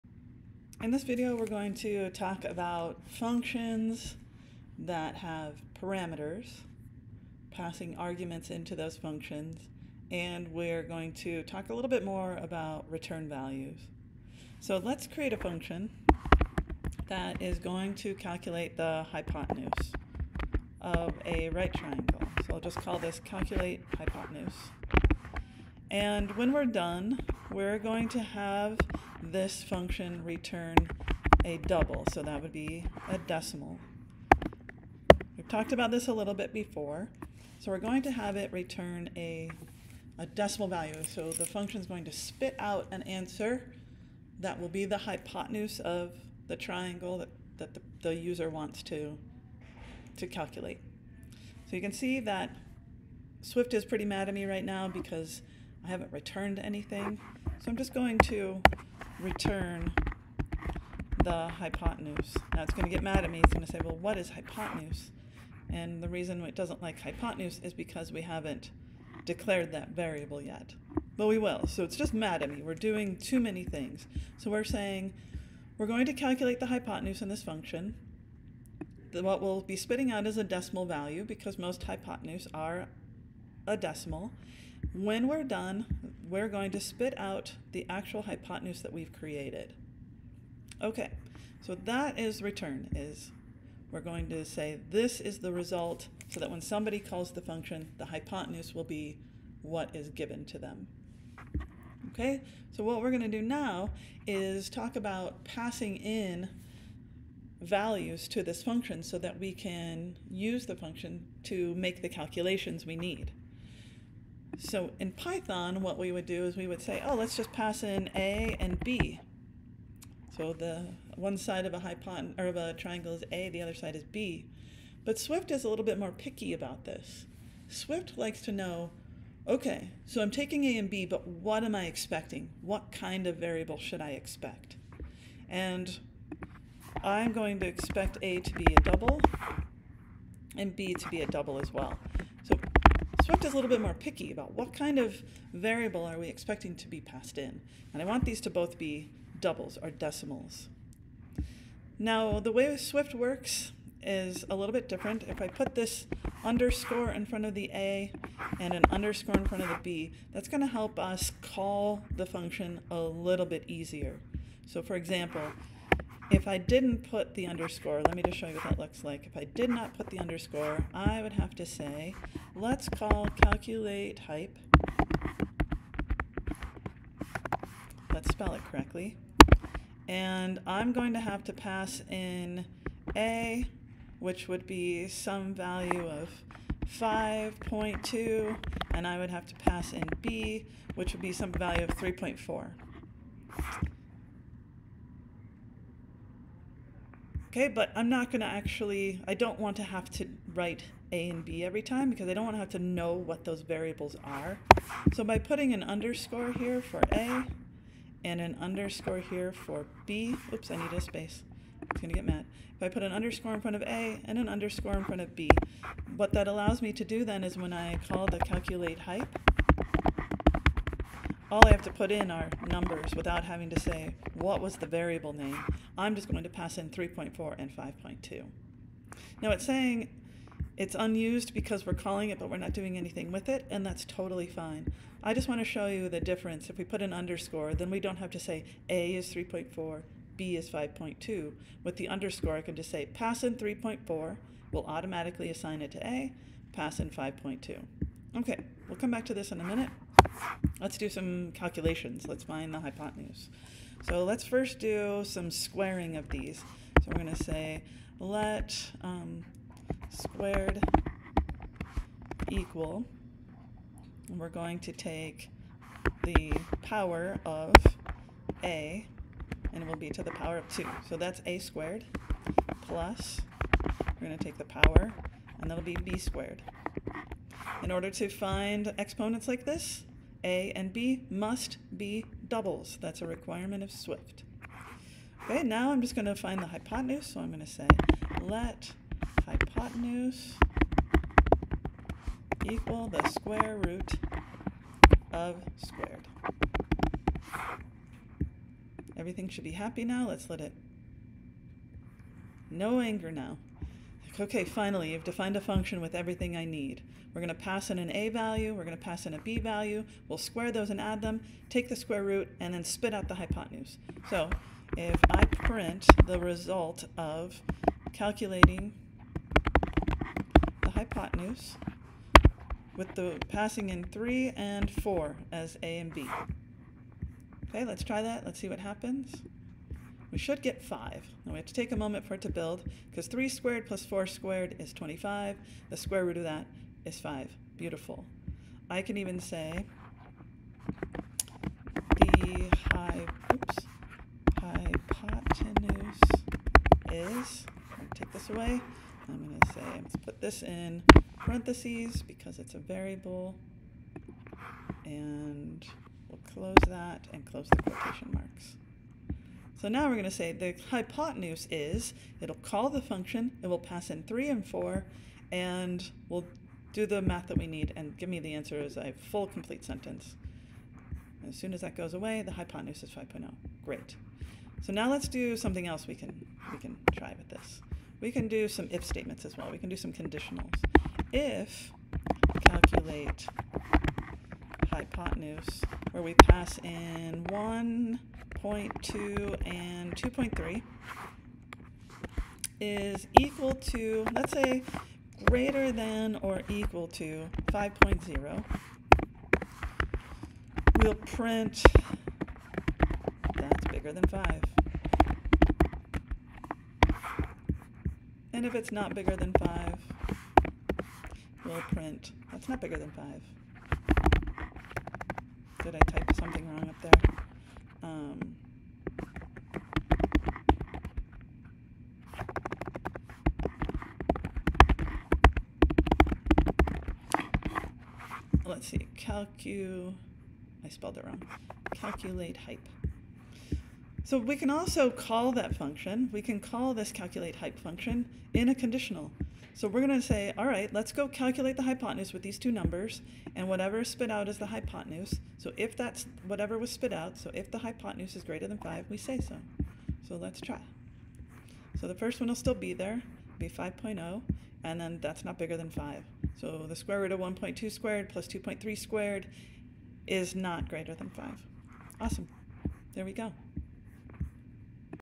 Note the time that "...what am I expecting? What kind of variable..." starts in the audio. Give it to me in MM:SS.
02:11.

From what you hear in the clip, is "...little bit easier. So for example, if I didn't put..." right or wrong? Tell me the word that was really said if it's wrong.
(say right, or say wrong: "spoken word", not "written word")
right.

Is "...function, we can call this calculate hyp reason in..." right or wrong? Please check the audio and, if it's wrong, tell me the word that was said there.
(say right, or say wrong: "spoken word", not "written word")
wrong: "function", not "reason".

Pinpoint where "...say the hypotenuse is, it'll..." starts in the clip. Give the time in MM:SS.
06:00.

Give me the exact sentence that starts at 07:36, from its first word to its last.
So the square root of 1.2 squared plus 2.3 squared is not greater than 5.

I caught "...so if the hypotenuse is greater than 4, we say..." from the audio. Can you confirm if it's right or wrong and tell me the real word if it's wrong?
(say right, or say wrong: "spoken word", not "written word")
wrong: "5", not "4".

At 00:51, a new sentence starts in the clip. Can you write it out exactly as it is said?
So you can see that Swift is pretty mad at me right now because I haven't returned anything.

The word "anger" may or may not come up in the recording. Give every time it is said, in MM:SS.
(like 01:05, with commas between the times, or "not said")
05:02.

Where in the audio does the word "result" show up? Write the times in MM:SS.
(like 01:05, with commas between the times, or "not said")
01:35, 05:16.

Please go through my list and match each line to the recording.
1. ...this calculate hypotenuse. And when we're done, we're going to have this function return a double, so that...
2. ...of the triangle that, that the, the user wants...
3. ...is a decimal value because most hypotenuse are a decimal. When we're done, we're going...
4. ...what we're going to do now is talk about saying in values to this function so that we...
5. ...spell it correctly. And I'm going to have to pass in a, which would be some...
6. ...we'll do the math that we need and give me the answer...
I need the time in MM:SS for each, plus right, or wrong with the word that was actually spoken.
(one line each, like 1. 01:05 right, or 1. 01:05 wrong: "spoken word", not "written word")
1. 00:22 right
2. 00:45 right
3. 01:20 right
4. 01:42 wrong: "passing", not "saying"
5. 02:58 right
6. 06:06 right.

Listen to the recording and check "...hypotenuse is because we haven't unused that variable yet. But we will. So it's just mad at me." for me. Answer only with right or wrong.
wrong.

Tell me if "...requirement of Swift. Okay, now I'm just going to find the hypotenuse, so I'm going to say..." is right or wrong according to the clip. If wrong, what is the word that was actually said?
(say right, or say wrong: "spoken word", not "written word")
right.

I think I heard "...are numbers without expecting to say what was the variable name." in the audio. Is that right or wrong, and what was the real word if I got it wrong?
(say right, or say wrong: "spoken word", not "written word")
wrong: "having", not "expecting".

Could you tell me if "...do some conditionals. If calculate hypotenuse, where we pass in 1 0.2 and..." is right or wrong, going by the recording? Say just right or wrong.
right.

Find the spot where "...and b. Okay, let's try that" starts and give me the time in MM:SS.
05:25.